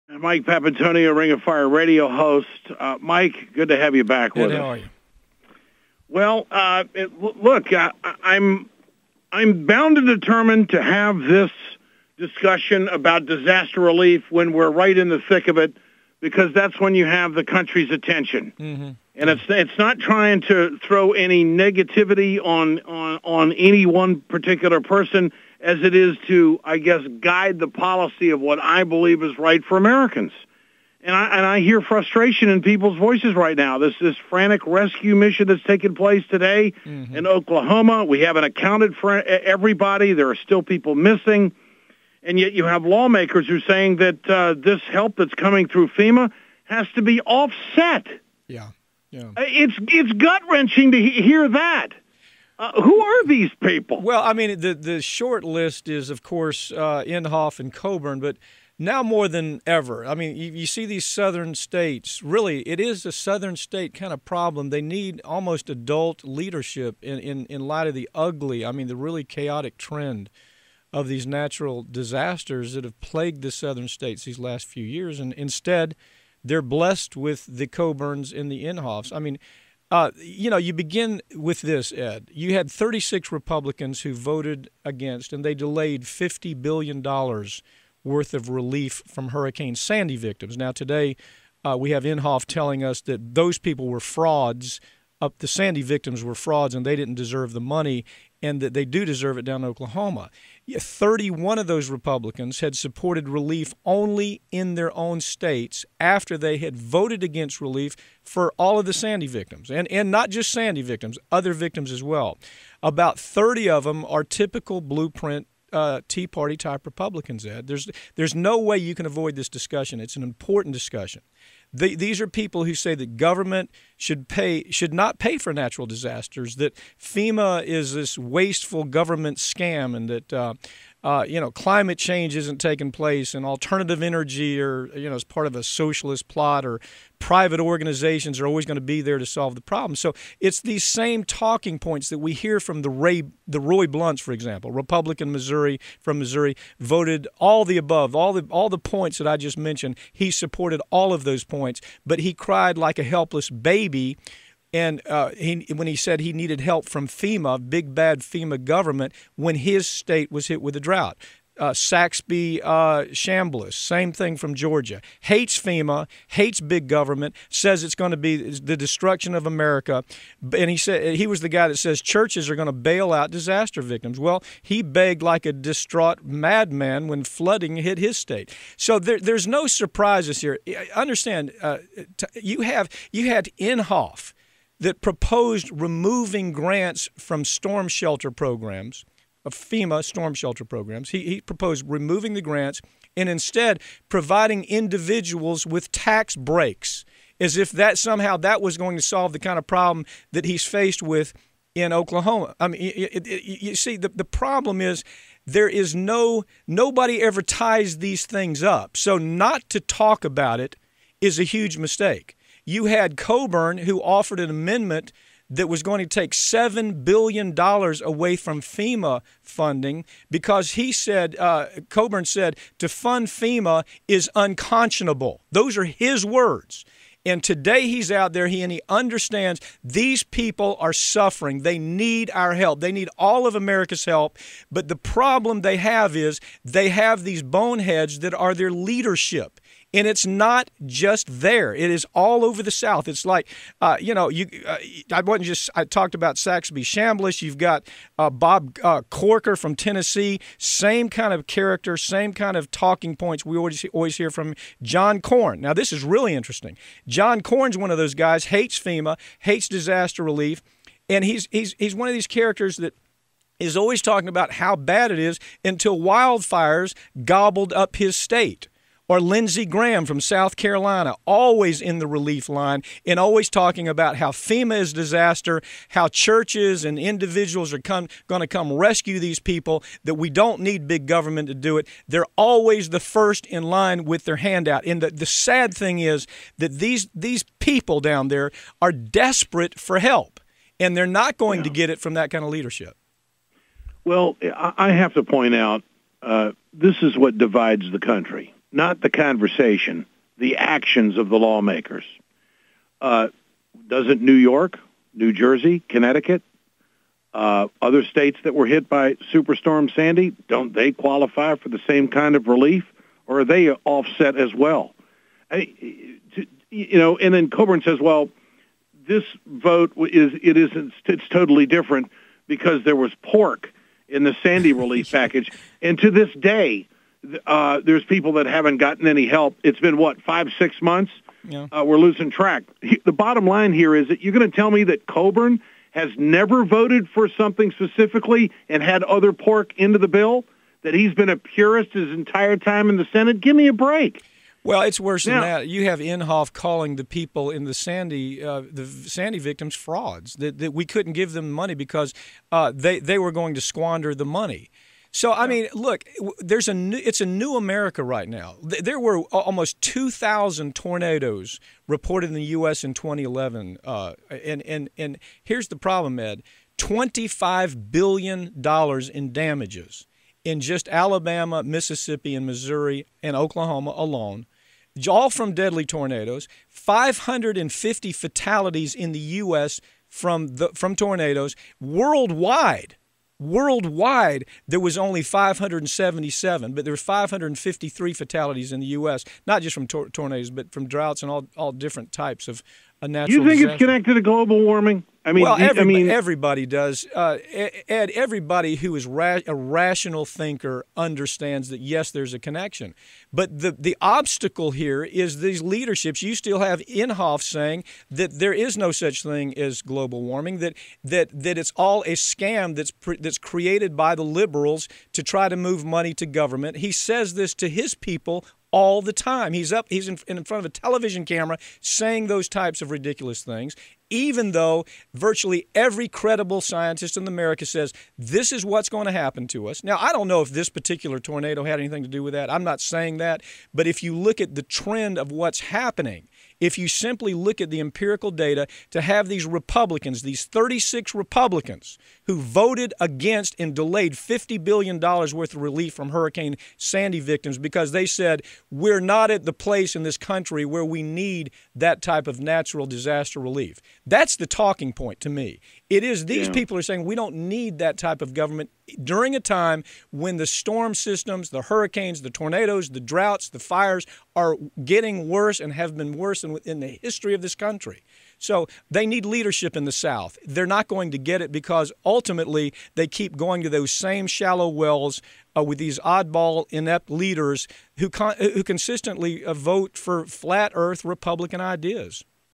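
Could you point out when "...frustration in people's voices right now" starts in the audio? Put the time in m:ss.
0:31.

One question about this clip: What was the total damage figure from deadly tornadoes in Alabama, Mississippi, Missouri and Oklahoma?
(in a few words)
$25 billion.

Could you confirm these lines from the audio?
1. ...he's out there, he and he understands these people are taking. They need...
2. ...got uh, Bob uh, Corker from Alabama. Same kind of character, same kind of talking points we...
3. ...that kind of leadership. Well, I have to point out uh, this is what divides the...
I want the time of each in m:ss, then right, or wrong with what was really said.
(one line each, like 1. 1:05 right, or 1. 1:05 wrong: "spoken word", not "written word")
1. 3:47 wrong: "suffering", not "taking"
2. 4:07 wrong: "Tennessee", not "Alabama"
3. 4:52 right.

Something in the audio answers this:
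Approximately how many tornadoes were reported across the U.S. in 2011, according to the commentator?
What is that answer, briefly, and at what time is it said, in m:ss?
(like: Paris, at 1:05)
2,000, at 5:59.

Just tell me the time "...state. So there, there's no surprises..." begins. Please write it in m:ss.
2:58.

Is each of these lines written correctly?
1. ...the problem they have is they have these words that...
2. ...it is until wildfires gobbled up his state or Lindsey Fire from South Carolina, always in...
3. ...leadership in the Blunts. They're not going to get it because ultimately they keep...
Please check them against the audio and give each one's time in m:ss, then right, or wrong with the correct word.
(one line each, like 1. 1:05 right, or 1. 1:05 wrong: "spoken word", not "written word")
1. 3:54 wrong: "boneheads", not "words"
2. 4:25 wrong: "Graham", not "Fire"
3. 7:49 wrong: "South", not "Blunts".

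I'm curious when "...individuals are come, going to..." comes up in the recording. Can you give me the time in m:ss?
4:36.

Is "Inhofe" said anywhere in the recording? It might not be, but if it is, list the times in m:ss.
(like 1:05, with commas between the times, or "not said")
0:57, 1:18, 1:32, 3:03, 5:45, 6:46.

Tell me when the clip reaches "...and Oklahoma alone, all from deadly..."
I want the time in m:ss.
6:13.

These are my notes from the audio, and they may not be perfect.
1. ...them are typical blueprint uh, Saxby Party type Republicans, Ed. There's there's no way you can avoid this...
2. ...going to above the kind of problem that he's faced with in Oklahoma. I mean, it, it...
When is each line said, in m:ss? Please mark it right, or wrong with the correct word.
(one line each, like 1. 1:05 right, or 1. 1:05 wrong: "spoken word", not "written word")
1. 1:53 wrong: "Tea", not "Saxby"
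2. 3:18 wrong: "solve", not "above".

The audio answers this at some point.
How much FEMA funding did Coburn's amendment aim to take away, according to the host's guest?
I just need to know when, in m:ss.
3:36.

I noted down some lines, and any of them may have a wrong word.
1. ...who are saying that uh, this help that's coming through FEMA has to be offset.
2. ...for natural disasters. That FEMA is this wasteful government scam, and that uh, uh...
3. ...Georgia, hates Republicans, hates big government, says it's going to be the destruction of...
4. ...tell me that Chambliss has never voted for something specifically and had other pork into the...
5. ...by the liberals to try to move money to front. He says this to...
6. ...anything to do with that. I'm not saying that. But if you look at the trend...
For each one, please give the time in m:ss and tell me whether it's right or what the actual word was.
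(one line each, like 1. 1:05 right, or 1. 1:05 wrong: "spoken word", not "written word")
1. 0:43 right
2. 2:05 right
3. 2:44 wrong: "FEMA", not "Republicans"
4. 5:34 wrong: "Coburn", not "Chambliss"
5. 6:53 wrong: "government", not "front"
6. 7:11 right.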